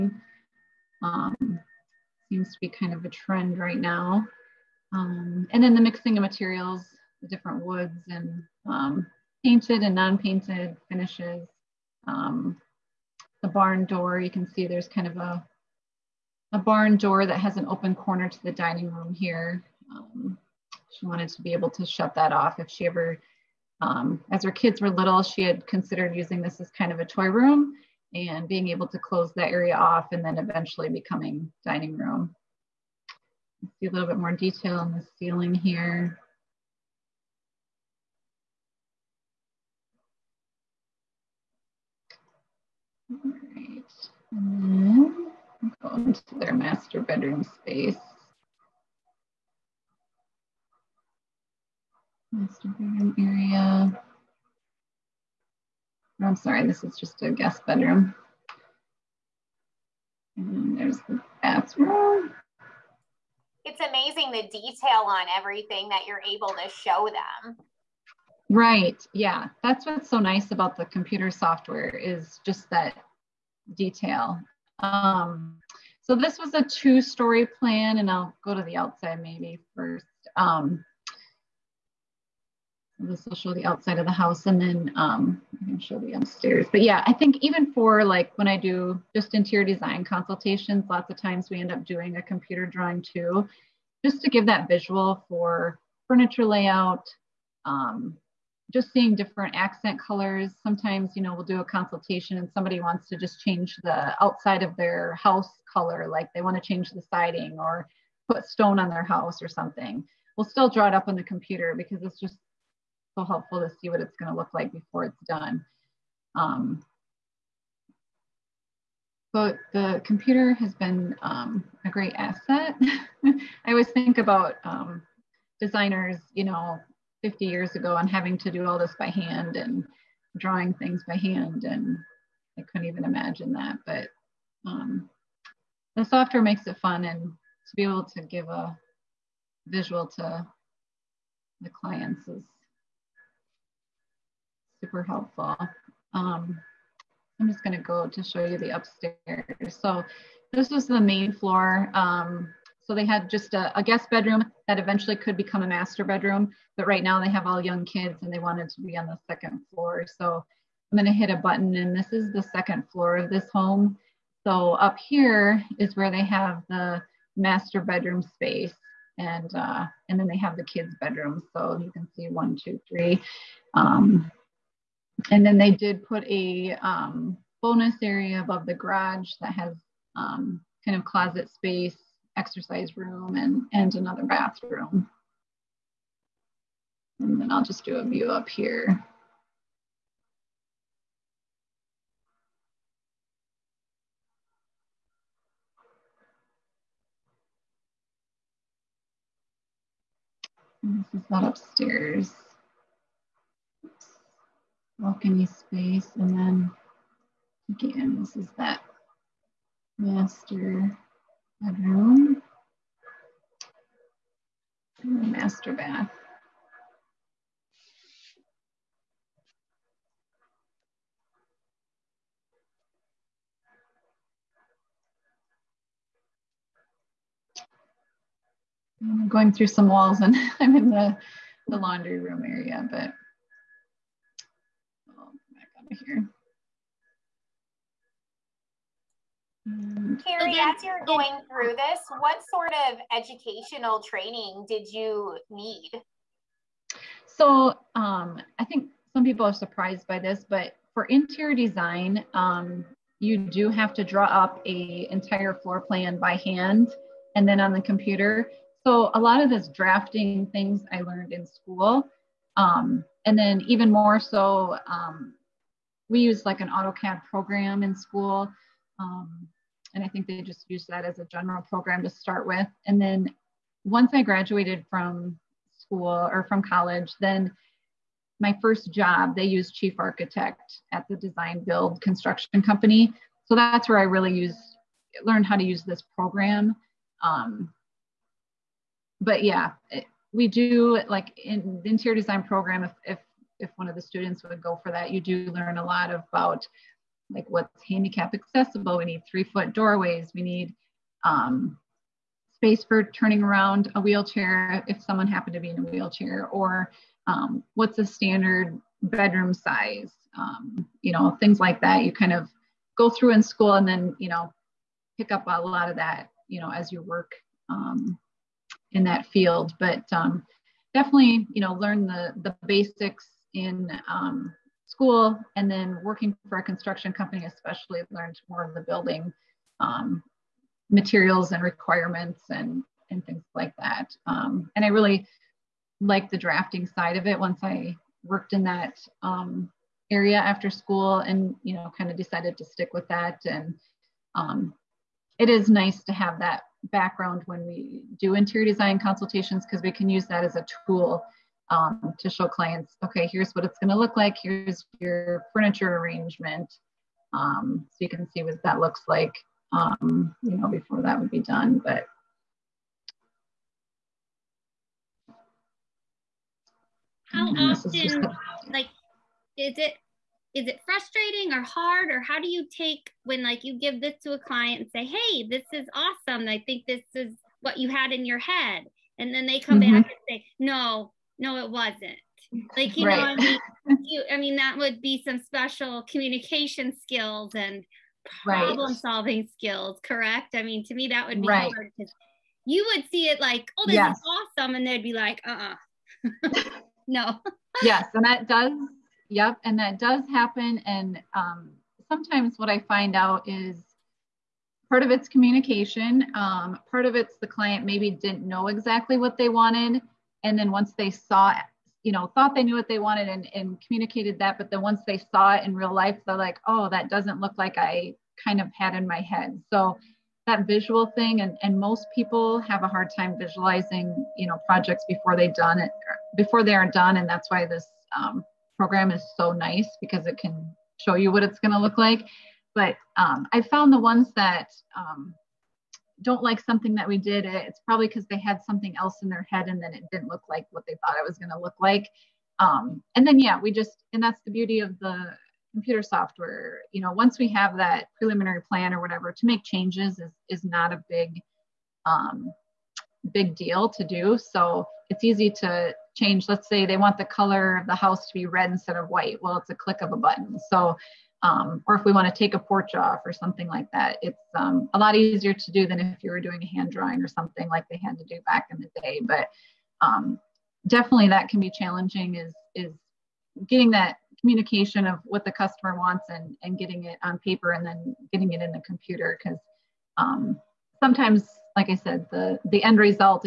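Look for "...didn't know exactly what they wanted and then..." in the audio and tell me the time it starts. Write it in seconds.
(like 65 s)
408 s.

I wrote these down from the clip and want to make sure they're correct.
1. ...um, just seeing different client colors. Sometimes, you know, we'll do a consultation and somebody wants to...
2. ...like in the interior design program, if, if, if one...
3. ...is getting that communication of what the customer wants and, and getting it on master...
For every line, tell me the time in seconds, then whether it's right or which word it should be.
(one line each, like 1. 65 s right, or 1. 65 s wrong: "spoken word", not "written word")
1. 97 s wrong: "accent", not "client"
2. 291 s right
3. 472 s wrong: "paper", not "master".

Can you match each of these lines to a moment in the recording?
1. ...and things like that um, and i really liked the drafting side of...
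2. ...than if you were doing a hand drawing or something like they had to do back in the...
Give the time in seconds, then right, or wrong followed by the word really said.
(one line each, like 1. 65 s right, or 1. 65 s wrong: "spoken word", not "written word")
1. 333 s right
2. 465 s right.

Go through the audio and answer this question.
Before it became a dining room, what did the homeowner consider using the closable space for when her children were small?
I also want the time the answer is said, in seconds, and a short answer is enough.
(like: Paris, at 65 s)
Toy room, at 27 s.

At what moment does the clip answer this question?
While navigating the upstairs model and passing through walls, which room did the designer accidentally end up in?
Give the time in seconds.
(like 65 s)
231 s.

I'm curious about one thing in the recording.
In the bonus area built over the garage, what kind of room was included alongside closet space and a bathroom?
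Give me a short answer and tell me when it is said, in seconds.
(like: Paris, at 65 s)
Exercise room, at 182 s.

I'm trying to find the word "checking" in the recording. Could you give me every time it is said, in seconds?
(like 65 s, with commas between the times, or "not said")
not said.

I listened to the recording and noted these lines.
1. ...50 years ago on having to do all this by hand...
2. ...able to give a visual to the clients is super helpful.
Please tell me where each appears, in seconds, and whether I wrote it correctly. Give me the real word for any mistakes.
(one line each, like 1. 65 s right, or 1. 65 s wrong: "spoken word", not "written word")
1. 127 s right
2. 137 s right.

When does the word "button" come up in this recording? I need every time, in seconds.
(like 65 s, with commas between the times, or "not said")
161 s, 460 s.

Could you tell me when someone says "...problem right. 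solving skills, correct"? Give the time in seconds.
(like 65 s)
388 s.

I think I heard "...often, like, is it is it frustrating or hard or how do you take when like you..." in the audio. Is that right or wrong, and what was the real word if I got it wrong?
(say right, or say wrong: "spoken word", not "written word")
right.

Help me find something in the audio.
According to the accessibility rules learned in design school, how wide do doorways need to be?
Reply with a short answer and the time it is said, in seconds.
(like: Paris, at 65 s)
3 feet, at 299 s.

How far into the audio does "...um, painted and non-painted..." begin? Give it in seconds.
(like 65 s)
8 s.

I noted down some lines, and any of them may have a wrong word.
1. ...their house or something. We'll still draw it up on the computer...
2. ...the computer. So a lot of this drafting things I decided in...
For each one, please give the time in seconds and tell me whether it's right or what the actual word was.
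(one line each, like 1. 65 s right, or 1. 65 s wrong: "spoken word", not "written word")
1. 108 s right
2. 257 s wrong: "learned", not "decided".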